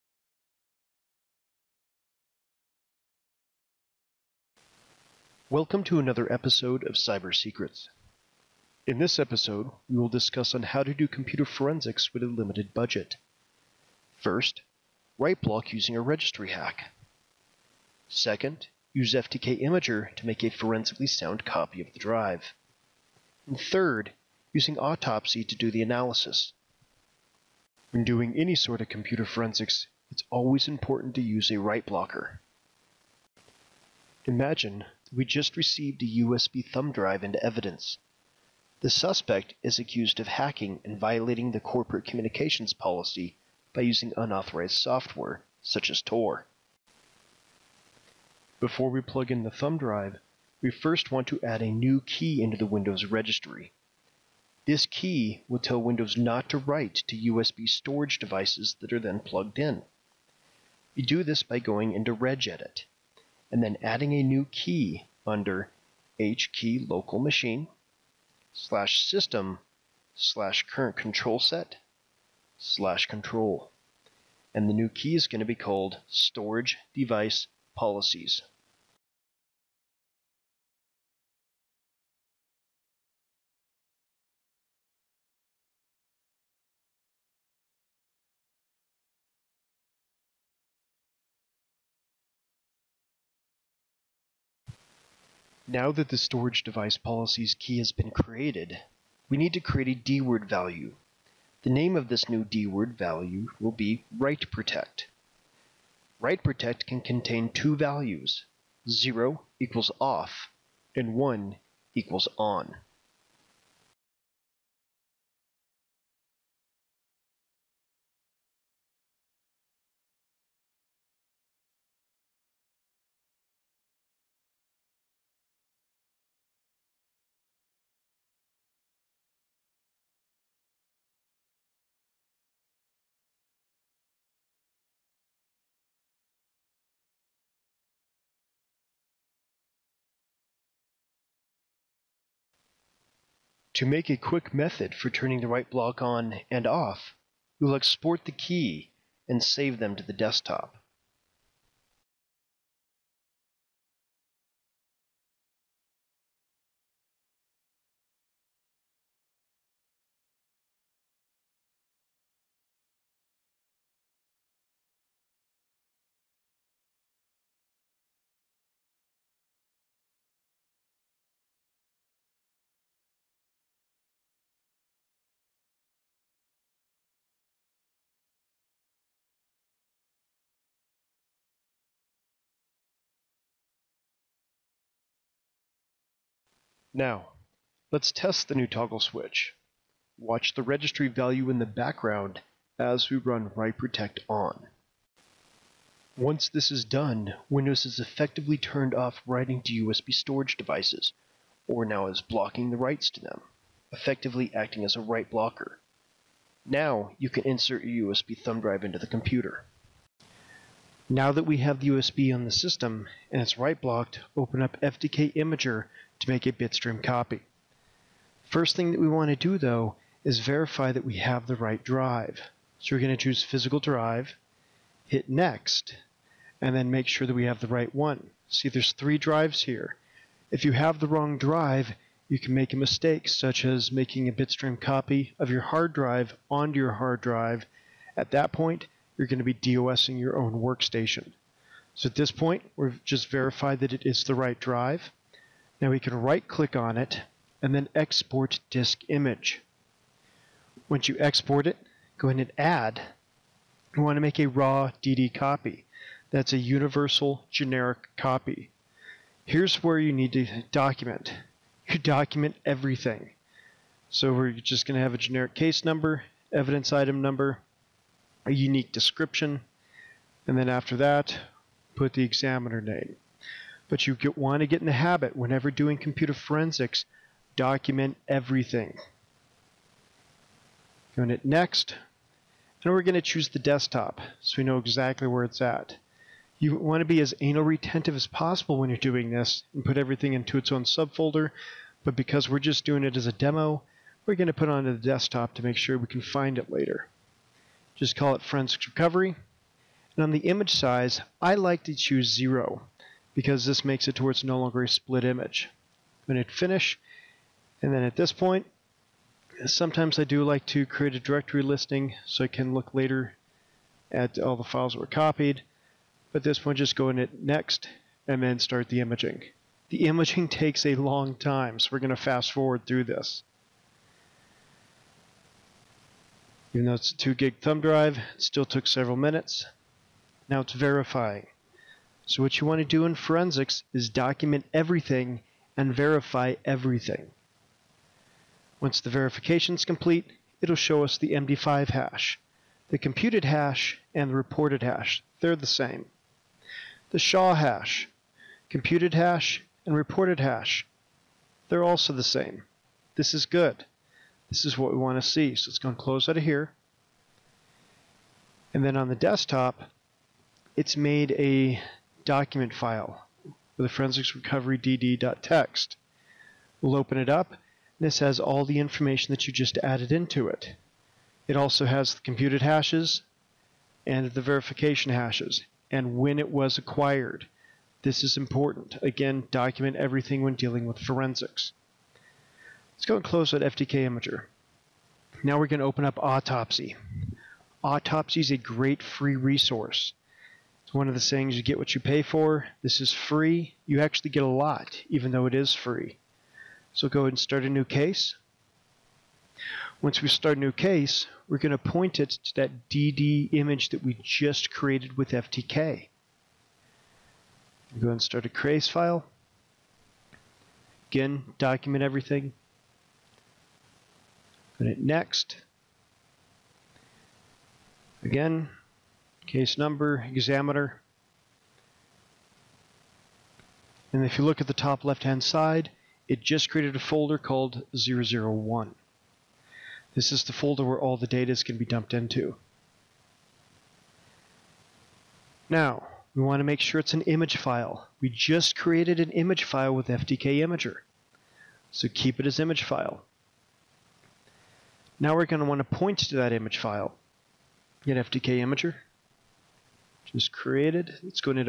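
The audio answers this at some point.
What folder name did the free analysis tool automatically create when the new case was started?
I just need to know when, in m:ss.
7:07.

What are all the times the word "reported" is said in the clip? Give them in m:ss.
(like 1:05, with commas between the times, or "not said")
5:44, 5:49.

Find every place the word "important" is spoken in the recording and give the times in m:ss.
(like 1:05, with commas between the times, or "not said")
0:30, 6:18.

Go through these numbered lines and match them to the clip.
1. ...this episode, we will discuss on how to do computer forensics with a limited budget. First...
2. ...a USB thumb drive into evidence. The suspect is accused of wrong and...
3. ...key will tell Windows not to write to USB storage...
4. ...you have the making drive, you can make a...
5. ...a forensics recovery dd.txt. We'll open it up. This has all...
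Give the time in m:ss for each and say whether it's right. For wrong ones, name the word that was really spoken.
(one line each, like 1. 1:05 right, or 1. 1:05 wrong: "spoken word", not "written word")
1. 0:08 right
2. 0:36 wrong: "hacking", not "wrong"
3. 0:54 right
4. 3:50 wrong: "wrong", not "making"
5. 6:03 right.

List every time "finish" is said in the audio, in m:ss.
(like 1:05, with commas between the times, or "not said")
5:06.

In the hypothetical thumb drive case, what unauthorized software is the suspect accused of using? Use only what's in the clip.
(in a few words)
Tor.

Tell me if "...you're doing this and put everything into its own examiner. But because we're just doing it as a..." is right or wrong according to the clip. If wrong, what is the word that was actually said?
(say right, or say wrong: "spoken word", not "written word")
wrong: "subfolder", not "examiner".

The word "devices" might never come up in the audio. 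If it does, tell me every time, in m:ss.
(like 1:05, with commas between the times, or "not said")
0:58, 1:16, 1:36, 3:20.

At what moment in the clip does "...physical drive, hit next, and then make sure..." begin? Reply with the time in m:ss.
3:43.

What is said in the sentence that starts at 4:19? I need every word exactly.
Here's where you need to document.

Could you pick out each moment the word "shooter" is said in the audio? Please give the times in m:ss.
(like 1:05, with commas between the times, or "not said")
not said.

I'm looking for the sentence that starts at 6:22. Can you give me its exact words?
Let's go and close out FTK Imager.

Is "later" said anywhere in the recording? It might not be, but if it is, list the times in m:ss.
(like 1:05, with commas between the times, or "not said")
4:56, 5:12.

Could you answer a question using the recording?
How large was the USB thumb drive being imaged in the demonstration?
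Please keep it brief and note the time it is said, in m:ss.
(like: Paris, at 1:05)
2 gig, at 5:27.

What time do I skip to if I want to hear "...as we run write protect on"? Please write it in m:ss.
3:12.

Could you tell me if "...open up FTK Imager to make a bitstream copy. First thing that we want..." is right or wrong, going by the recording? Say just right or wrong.
right.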